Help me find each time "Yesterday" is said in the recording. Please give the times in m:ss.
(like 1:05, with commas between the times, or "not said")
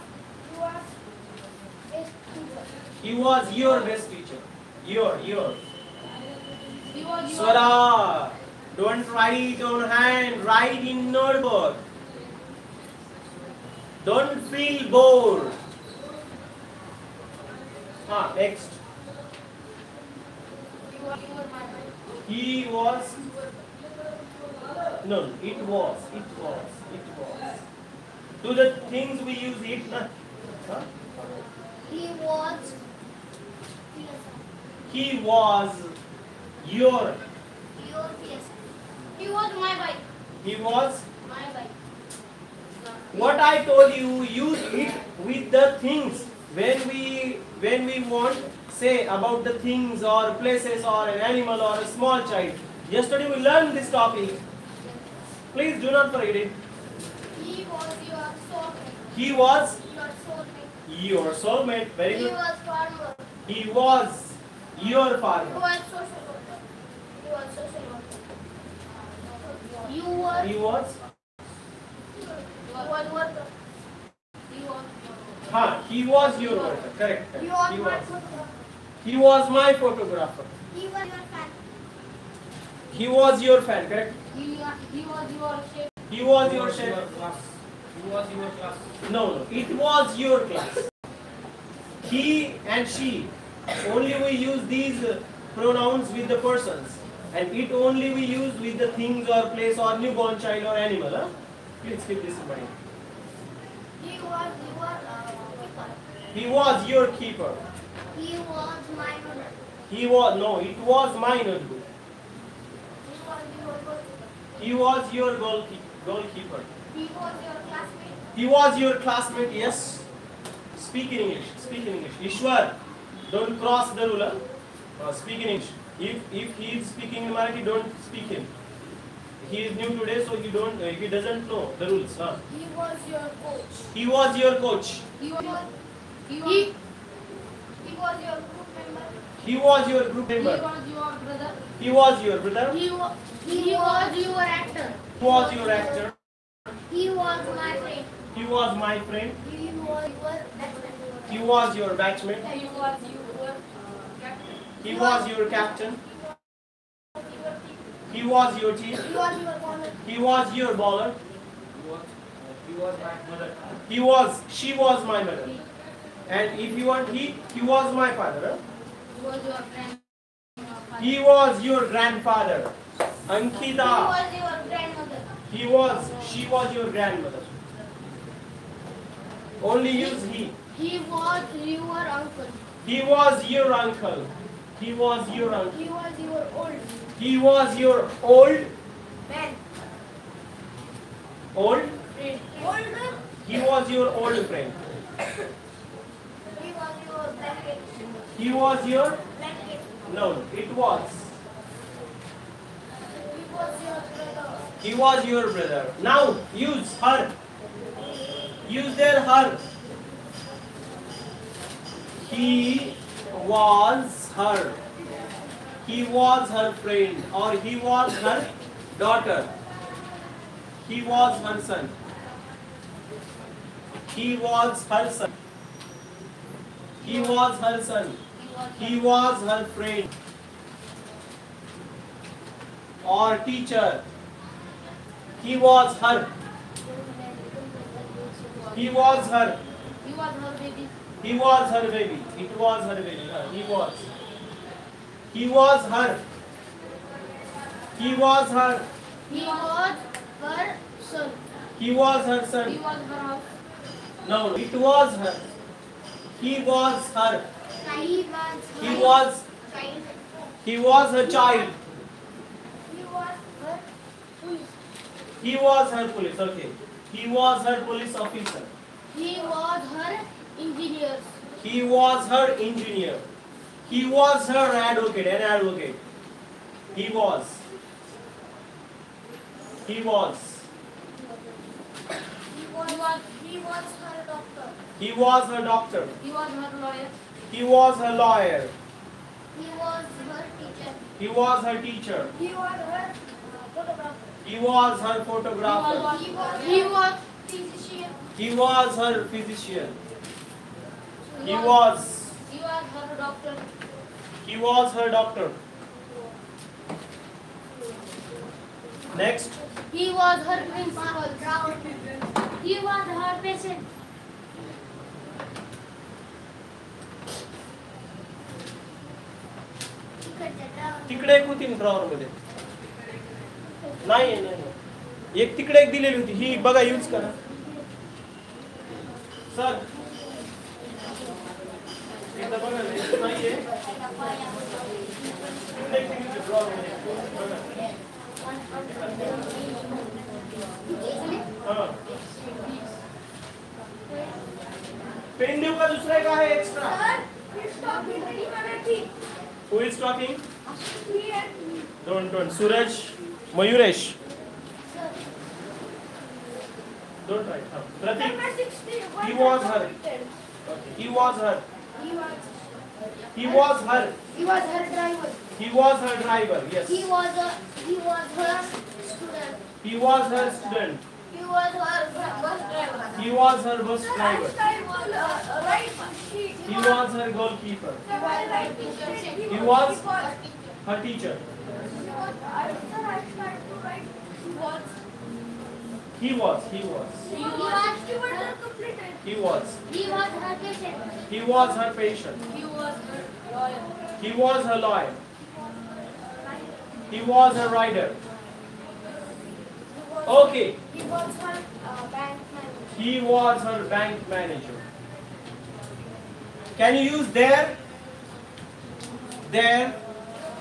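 0:52.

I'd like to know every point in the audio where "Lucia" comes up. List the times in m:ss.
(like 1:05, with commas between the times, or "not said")
not said.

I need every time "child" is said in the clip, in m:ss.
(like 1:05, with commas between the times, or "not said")
0:52, 1:40, 4:21.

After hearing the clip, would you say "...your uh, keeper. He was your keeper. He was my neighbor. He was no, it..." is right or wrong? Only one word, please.
right.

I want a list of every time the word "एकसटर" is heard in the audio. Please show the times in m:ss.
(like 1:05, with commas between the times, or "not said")
5:46.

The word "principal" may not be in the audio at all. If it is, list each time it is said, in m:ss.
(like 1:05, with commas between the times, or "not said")
5:10.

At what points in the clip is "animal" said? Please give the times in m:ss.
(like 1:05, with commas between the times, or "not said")
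0:51, 1:40.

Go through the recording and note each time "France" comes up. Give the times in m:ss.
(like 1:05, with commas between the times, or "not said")
not said.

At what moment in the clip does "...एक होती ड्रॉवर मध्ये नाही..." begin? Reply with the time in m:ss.
5:21.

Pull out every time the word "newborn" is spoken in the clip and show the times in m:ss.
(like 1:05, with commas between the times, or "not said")
1:39.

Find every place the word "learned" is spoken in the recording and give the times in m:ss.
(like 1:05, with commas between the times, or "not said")
0:53.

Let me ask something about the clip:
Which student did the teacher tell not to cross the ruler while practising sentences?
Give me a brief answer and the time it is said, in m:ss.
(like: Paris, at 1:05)
Ishwar, at 2:02.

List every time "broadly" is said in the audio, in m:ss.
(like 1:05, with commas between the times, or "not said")
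not said.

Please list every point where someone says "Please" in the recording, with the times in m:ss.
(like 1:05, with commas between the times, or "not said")
0:55, 1:41.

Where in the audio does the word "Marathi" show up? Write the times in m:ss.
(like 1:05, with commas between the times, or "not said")
2:07.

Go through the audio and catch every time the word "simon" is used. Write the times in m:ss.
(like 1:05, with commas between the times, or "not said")
not said.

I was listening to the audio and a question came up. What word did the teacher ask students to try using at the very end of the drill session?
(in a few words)
there.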